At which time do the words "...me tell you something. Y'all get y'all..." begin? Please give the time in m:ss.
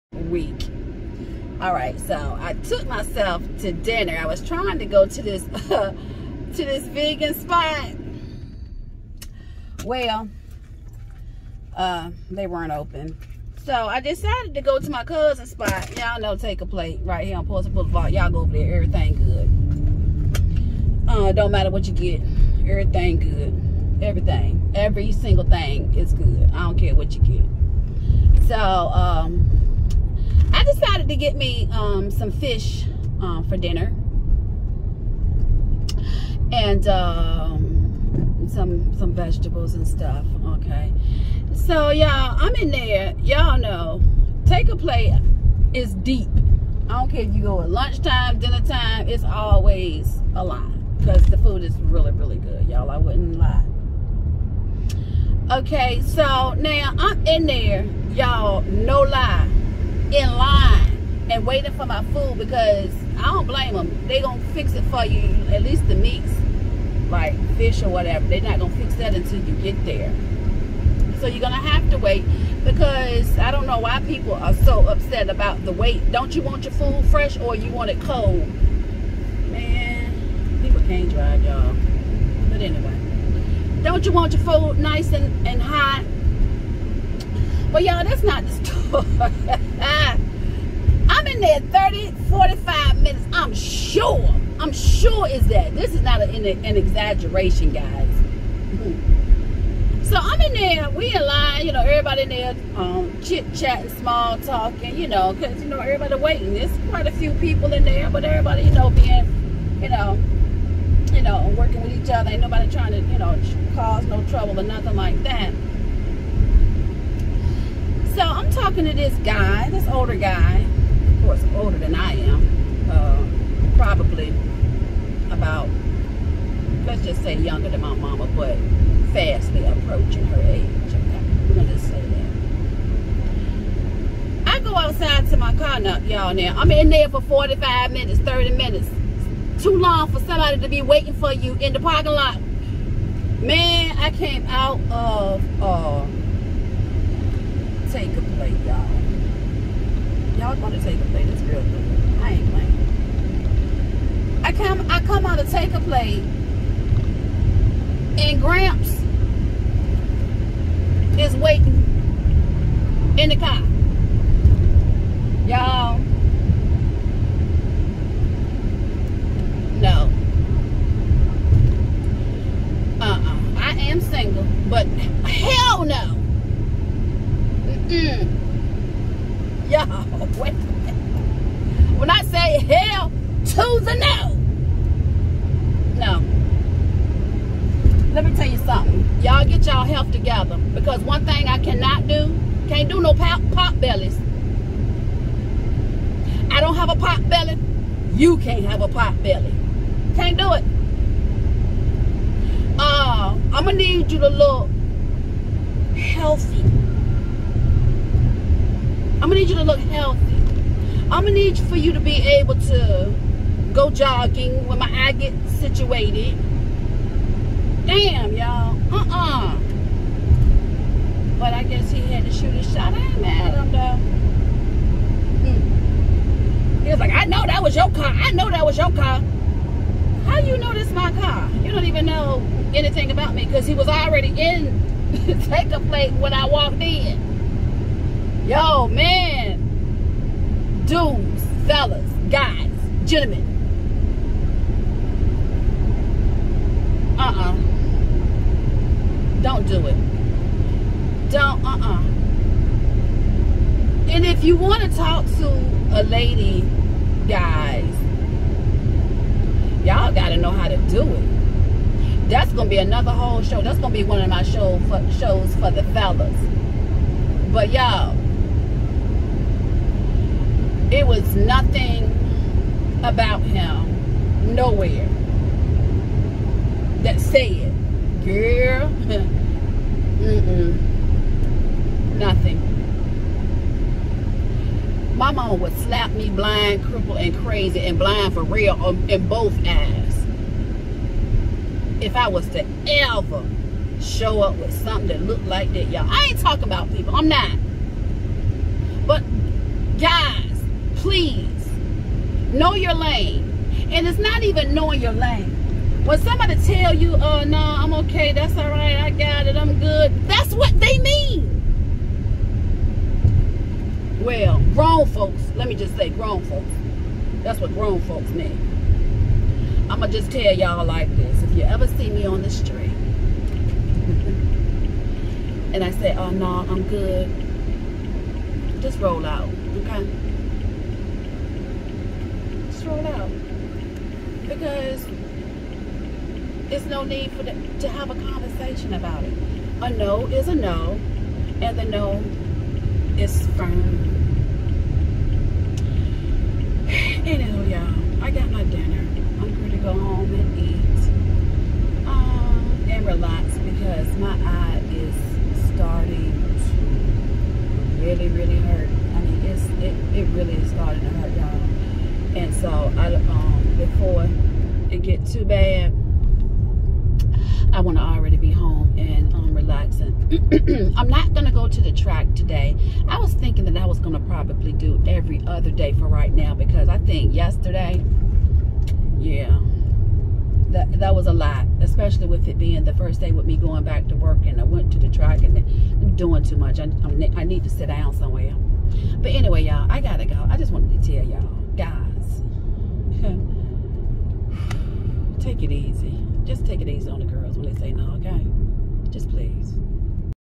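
3:08.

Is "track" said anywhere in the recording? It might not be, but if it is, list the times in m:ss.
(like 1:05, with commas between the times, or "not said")
6:11, 6:25.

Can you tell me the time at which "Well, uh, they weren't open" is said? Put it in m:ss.
0:09.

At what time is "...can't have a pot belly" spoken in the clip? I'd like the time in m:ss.
3:18.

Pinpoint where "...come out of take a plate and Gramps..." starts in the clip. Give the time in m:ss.
2:35.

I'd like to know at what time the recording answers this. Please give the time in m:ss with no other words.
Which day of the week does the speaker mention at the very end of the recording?
6:37.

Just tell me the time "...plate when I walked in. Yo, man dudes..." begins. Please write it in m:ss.
3:55.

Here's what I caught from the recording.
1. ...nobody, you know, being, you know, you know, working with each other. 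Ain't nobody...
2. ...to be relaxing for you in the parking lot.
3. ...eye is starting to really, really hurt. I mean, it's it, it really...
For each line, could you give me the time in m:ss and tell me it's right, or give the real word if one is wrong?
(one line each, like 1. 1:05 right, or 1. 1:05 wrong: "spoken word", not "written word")
1. 1:48 wrong: "everybody", not "nobody"
2. 2:20 wrong: "waiting", not "relaxing"
3. 5:54 right.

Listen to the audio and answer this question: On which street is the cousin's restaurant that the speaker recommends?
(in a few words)
Pulse Boulevard.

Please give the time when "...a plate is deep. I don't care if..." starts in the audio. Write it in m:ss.
0:44.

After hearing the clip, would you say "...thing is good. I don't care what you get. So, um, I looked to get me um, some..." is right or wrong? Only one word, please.
wrong.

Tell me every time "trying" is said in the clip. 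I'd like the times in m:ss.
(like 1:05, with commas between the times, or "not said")
0:04, 1:52.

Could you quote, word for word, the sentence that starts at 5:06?
When somebody tell you, oh, no, I'm okay, that's all right, I got it, I'm good, that's what they mean.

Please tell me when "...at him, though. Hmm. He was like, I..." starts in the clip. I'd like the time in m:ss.
3:43.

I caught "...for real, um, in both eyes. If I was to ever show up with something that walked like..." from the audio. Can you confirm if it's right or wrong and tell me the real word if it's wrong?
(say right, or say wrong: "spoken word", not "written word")
wrong: "looked", not "walked".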